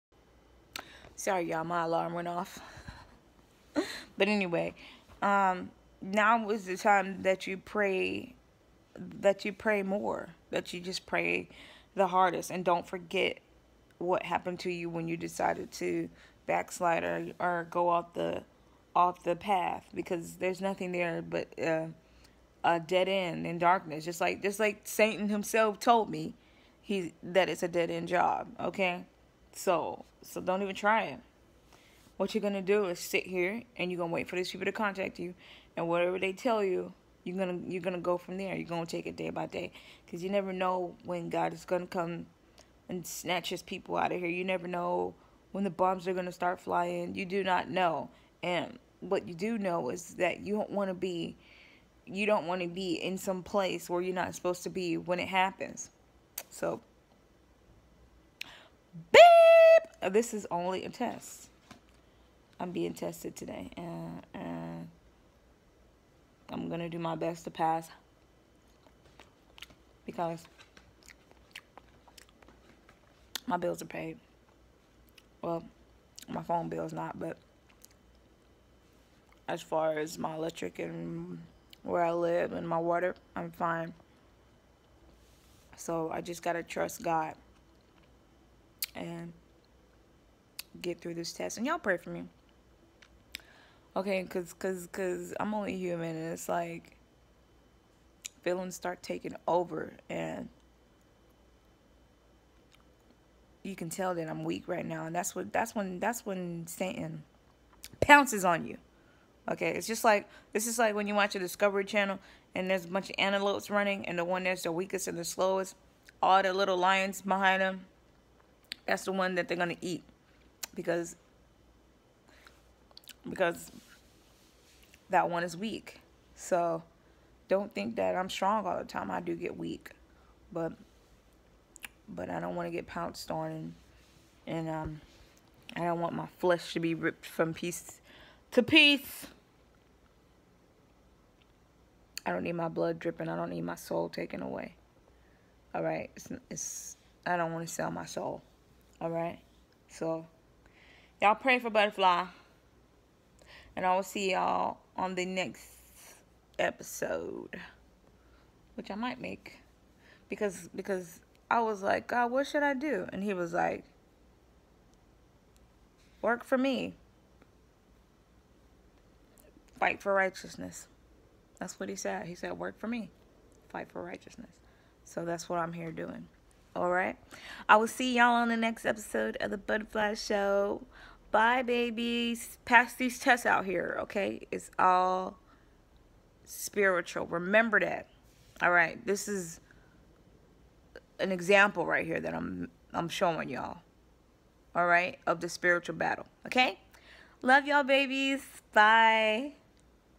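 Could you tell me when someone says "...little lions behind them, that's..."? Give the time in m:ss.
1:56.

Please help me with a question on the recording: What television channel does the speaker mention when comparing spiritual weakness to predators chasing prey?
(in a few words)
Discovery Channel.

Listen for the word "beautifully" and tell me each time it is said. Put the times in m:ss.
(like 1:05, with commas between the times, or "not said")
not said.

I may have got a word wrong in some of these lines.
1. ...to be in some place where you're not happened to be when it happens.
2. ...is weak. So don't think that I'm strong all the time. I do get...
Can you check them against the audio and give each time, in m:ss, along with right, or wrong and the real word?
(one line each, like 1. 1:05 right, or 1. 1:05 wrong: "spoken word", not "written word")
1. 0:52 wrong: "supposed", not "happened"
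2. 2:05 right.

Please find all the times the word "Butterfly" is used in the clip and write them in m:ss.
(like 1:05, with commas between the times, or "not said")
2:31, 2:59.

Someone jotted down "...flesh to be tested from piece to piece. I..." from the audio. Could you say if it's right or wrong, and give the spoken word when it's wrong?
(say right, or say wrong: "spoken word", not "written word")
wrong: "ripped", not "tested".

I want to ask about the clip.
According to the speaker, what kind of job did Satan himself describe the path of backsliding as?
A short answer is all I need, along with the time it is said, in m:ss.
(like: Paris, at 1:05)
dead end job, at 0:27.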